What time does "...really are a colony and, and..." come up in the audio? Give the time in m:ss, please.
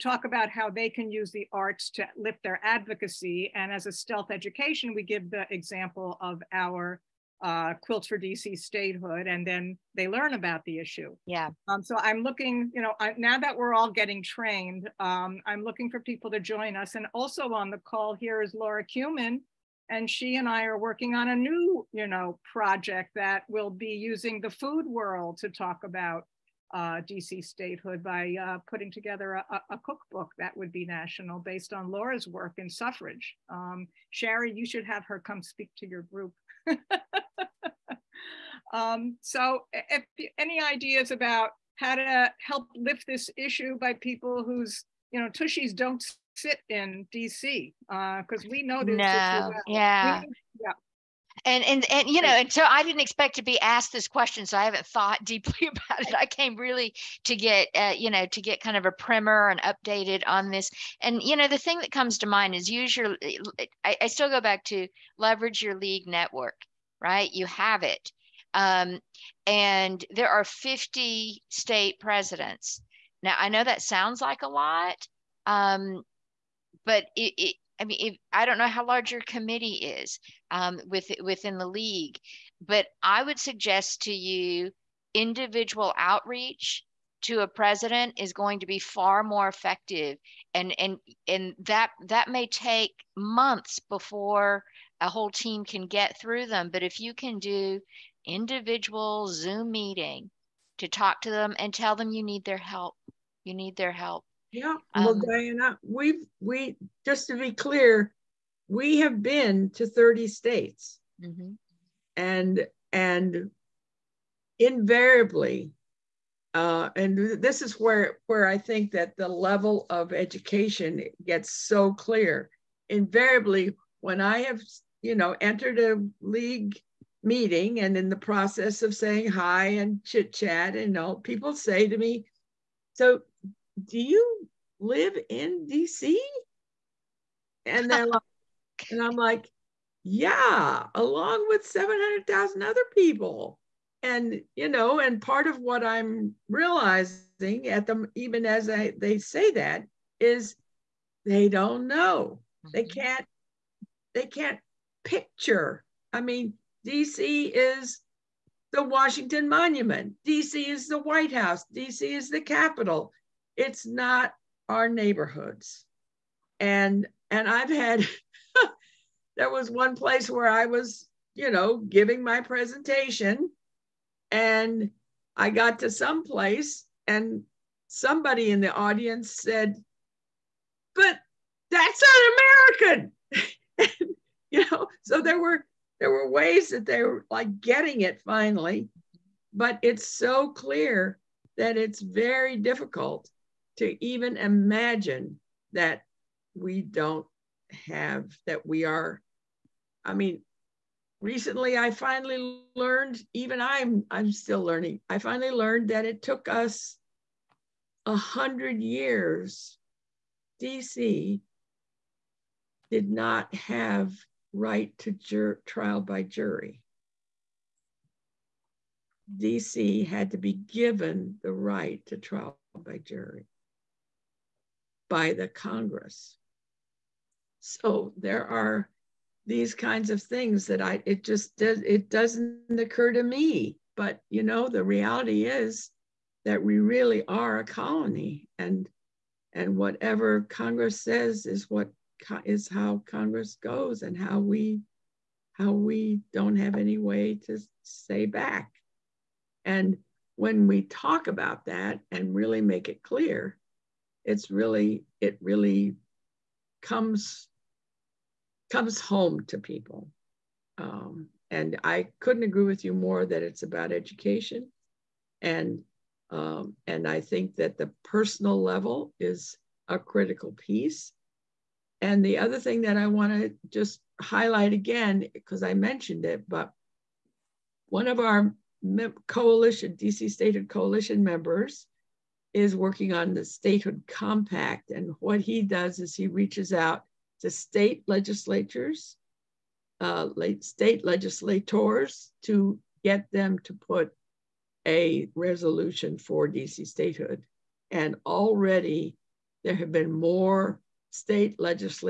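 3:56.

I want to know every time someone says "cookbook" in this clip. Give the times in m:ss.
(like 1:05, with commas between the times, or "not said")
0:29.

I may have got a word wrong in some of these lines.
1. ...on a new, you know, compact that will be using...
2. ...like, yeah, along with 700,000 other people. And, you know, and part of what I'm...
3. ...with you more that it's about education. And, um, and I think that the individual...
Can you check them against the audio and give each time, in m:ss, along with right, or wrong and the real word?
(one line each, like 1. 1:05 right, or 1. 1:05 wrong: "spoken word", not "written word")
1. 0:21 wrong: "project", not "compact"
2. 2:19 right
3. 4:22 wrong: "personal", not "individual".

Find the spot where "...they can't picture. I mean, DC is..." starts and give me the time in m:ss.
2:34.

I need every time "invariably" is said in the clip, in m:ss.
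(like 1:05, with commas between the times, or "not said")
1:54, 2:02.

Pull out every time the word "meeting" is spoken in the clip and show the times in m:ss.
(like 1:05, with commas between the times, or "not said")
1:39, 2:07.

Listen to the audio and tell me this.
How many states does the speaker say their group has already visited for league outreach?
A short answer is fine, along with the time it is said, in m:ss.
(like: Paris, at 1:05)
30, at 1:49.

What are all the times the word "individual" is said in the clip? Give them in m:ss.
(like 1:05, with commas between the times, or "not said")
1:25, 1:38.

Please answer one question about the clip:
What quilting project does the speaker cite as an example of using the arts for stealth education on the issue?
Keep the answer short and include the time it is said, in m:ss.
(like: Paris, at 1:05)
Quilts for DC statehood, at 0:07.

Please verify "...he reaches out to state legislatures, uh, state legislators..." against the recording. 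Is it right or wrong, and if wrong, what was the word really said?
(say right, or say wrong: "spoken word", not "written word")
right.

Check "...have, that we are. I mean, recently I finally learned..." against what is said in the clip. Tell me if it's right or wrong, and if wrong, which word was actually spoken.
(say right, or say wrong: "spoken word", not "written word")
right.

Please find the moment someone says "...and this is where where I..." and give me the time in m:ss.
1:56.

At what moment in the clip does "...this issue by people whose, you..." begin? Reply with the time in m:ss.
0:43.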